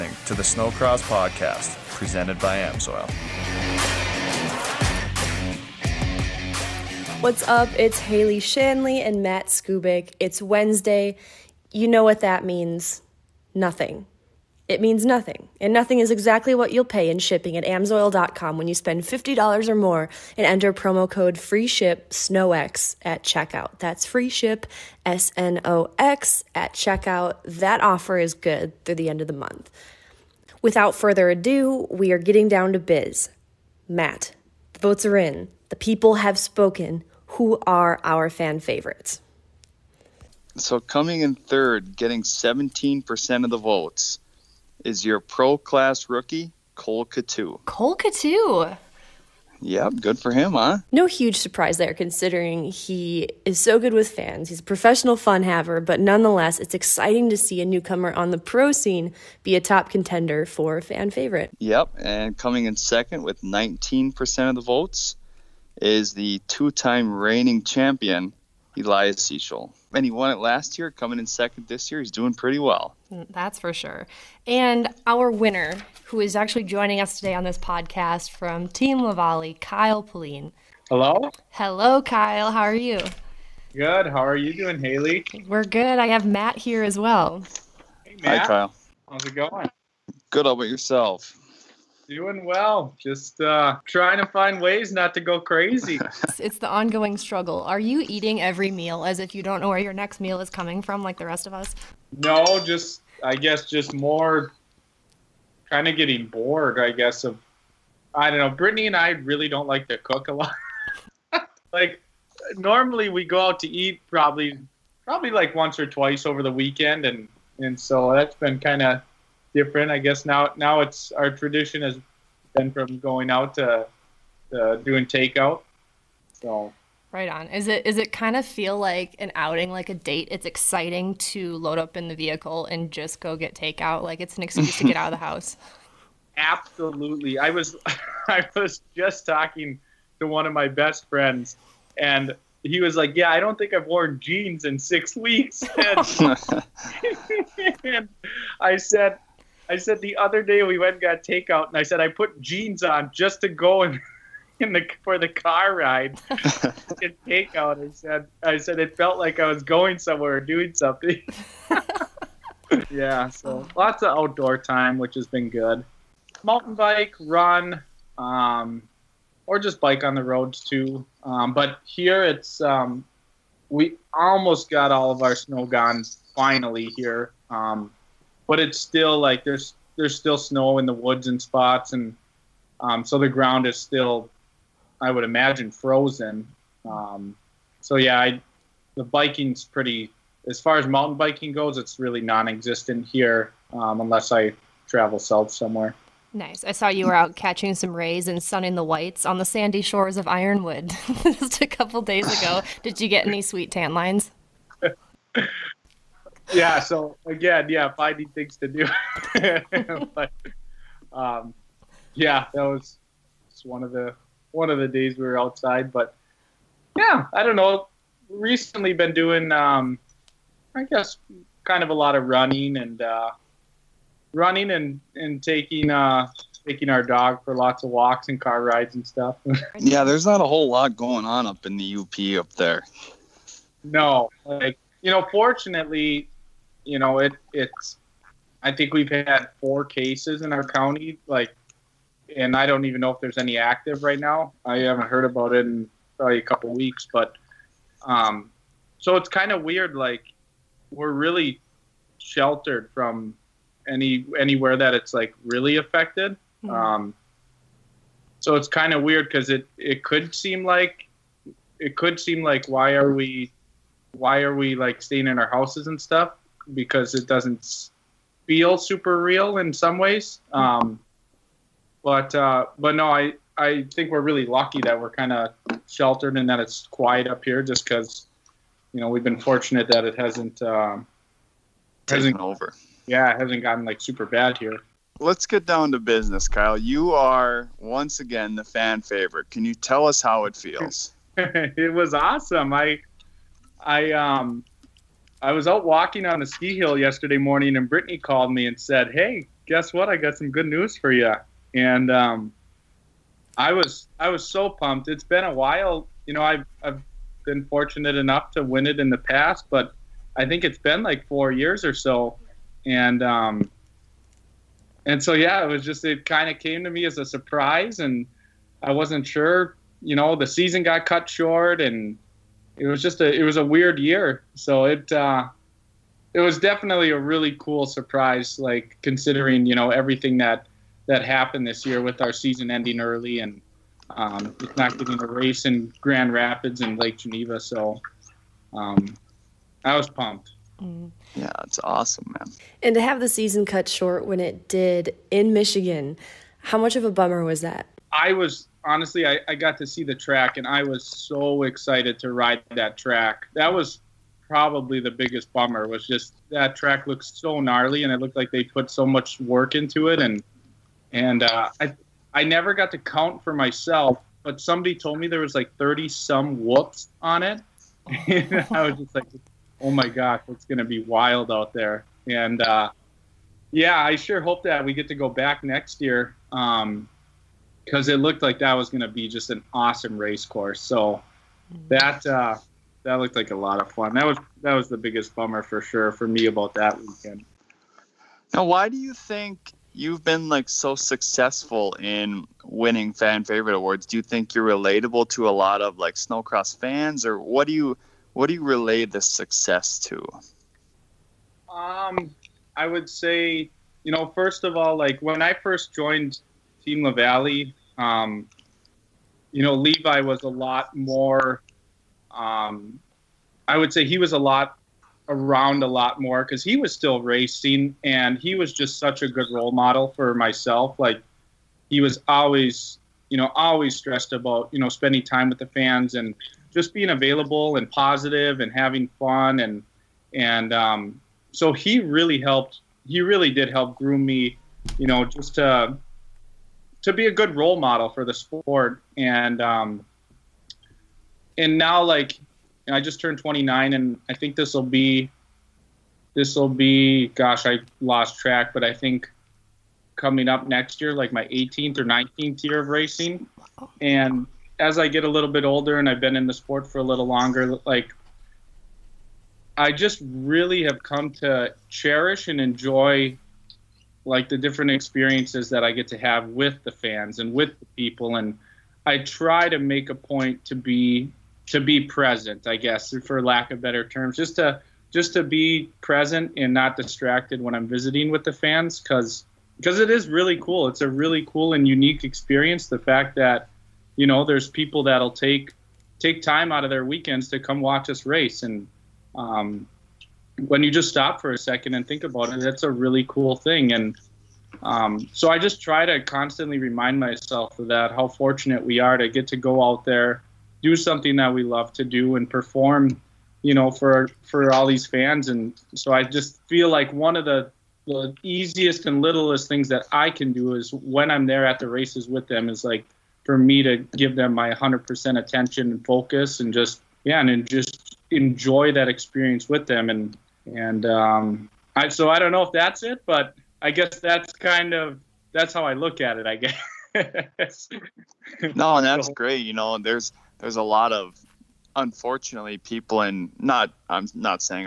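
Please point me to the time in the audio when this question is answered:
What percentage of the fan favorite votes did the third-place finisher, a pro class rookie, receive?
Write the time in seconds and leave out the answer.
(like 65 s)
42 s.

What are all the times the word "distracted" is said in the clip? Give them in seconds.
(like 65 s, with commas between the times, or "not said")
476 s.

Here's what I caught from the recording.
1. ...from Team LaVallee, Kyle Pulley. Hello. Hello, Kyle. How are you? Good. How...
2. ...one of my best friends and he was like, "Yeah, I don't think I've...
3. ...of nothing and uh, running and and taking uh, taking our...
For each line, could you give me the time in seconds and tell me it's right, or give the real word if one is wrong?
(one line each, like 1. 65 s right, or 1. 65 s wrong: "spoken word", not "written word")
1. 78 s right
2. 140 s right
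3. 222 s wrong: "running", not "nothing".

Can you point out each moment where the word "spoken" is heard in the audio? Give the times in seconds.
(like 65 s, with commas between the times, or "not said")
36 s.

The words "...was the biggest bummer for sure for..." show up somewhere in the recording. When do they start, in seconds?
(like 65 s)
384 s.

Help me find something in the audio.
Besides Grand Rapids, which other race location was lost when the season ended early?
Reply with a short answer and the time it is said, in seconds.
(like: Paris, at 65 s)
Lake Geneva, at 336 s.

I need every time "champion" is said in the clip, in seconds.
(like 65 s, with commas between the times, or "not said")
67 s.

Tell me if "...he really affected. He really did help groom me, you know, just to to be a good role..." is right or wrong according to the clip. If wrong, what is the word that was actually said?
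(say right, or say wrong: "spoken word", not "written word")
wrong: "helped", not "affected".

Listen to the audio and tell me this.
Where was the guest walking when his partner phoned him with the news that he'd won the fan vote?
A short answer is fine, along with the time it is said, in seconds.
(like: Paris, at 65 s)
The ski hill, at 296 s.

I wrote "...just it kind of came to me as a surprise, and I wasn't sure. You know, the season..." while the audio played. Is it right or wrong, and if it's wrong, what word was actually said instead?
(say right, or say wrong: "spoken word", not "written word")
right.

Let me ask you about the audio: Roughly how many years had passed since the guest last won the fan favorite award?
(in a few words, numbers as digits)
4 years.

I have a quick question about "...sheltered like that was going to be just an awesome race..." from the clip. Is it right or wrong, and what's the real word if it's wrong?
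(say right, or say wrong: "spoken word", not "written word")
wrong: "looked", not "sheltered".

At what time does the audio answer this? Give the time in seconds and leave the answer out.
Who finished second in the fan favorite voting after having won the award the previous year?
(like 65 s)
68 s.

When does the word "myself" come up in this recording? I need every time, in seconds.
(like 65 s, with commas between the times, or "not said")
363 s, 420 s, 497 s.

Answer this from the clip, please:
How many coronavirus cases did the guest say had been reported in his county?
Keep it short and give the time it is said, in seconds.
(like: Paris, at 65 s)
4, at 239 s.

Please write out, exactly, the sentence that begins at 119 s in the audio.
I guess now now it's our tradition has been from going out to, to doing takeout.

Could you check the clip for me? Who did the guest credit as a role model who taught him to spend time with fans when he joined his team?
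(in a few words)
Levi.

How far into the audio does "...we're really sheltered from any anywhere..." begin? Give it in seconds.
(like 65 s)
250 s.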